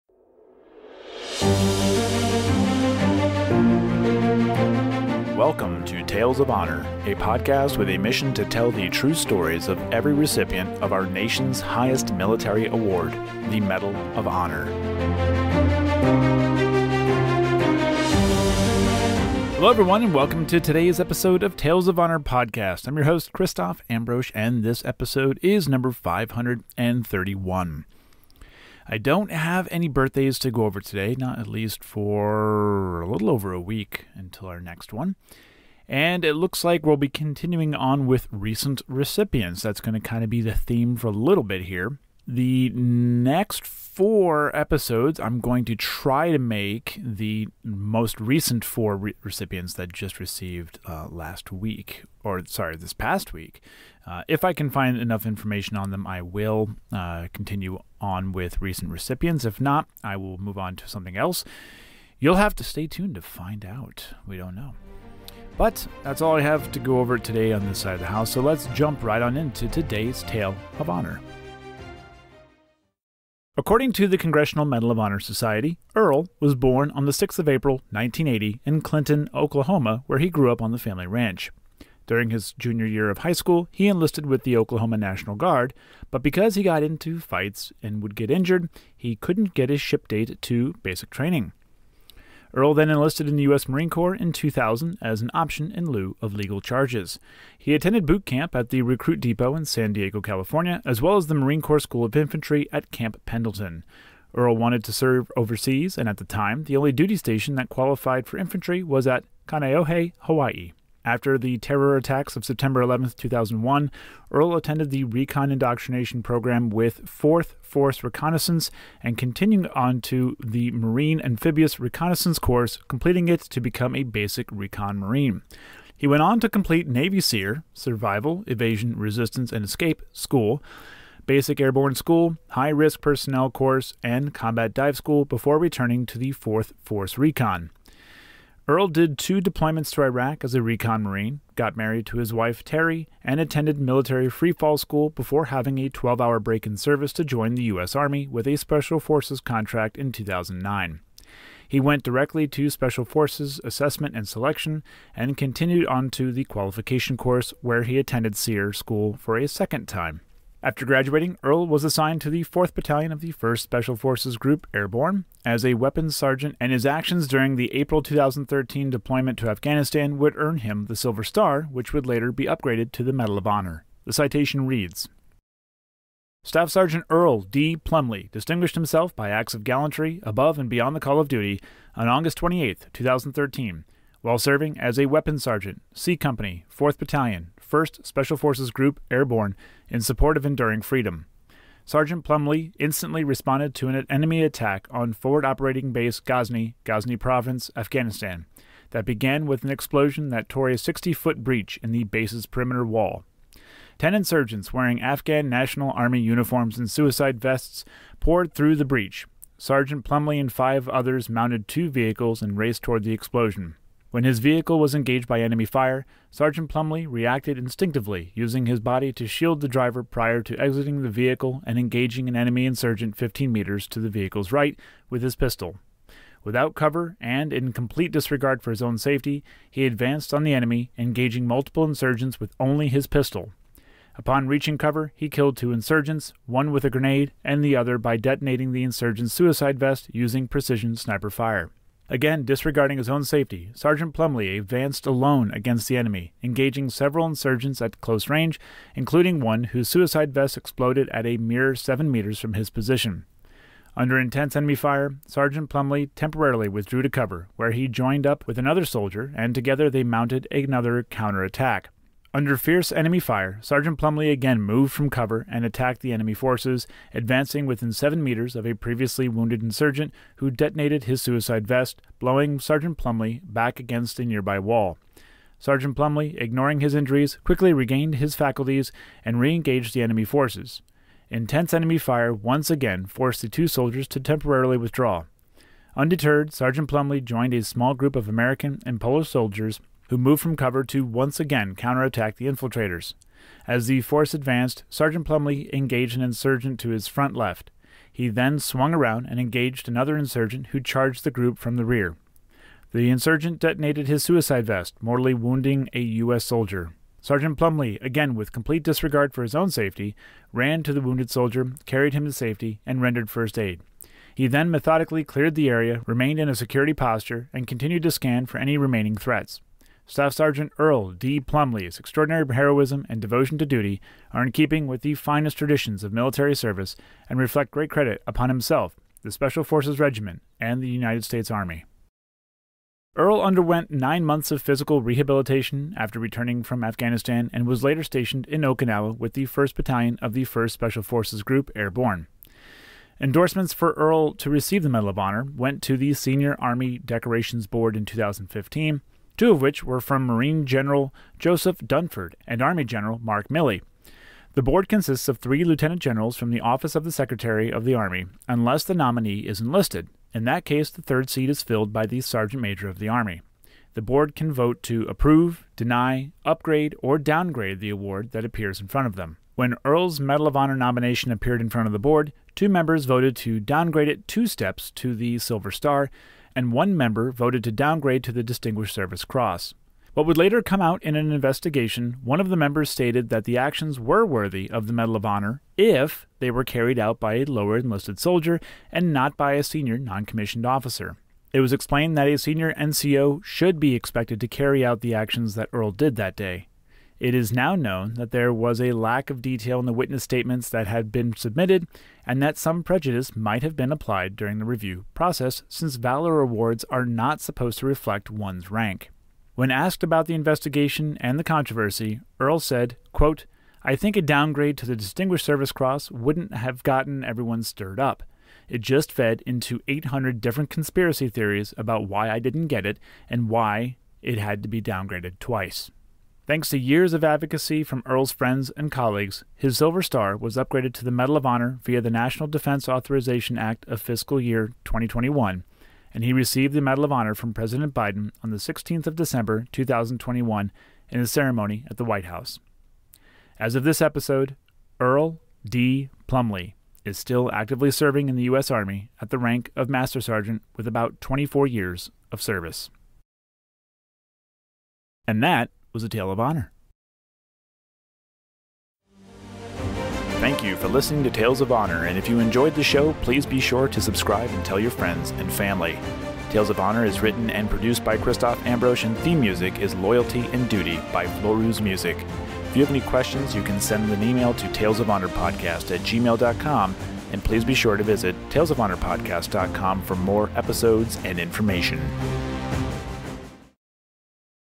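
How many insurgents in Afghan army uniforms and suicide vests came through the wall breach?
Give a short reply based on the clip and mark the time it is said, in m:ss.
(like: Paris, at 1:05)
Ten, at 3:23.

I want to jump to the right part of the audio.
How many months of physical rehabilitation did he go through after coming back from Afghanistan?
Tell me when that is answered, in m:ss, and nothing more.
5:33.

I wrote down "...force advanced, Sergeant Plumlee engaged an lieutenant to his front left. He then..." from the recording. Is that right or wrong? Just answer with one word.
wrong.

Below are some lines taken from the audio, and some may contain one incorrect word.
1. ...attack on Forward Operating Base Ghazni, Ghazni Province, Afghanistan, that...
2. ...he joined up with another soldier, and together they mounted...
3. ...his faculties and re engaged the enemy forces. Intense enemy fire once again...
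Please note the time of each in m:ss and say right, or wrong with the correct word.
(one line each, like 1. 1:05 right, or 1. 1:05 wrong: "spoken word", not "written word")
1. 3:14 right
2. 4:17 right
3. 4:38 right.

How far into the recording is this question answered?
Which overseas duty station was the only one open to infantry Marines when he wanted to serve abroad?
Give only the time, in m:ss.
1:49.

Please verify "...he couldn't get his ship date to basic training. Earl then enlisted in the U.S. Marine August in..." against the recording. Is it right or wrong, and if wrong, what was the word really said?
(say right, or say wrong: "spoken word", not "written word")
wrong: "Corps", not "August".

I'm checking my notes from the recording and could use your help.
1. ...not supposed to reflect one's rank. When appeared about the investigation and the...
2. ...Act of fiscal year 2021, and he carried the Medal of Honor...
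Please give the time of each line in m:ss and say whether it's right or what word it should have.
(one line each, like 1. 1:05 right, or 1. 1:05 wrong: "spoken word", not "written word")
1. 6:47 wrong: "asked", not "appeared"
2. 7:13 wrong: "received", not "carried".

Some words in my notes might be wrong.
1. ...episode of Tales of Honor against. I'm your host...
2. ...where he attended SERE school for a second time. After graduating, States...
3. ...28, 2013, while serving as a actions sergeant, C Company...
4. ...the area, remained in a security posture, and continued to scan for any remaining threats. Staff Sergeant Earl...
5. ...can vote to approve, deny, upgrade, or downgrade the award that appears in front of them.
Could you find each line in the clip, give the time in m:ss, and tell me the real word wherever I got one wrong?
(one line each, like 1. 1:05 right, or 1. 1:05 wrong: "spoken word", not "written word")
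1. 0:21 wrong: "podcast", not "against"
2. 2:37 wrong: "Earl", not "States"
3. 3:02 wrong: "weapons", not "actions"
4. 5:15 right
5. 6:04 right.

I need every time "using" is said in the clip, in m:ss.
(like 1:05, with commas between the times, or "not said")
3:38, 4:00.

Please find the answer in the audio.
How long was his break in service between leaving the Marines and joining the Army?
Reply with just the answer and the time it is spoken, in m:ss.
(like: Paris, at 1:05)
12 hours, at 2:25.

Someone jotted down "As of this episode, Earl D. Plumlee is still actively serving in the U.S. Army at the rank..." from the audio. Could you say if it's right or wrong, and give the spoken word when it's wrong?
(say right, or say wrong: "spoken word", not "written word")
right.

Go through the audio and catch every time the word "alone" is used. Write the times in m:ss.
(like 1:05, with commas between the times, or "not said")
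4:05.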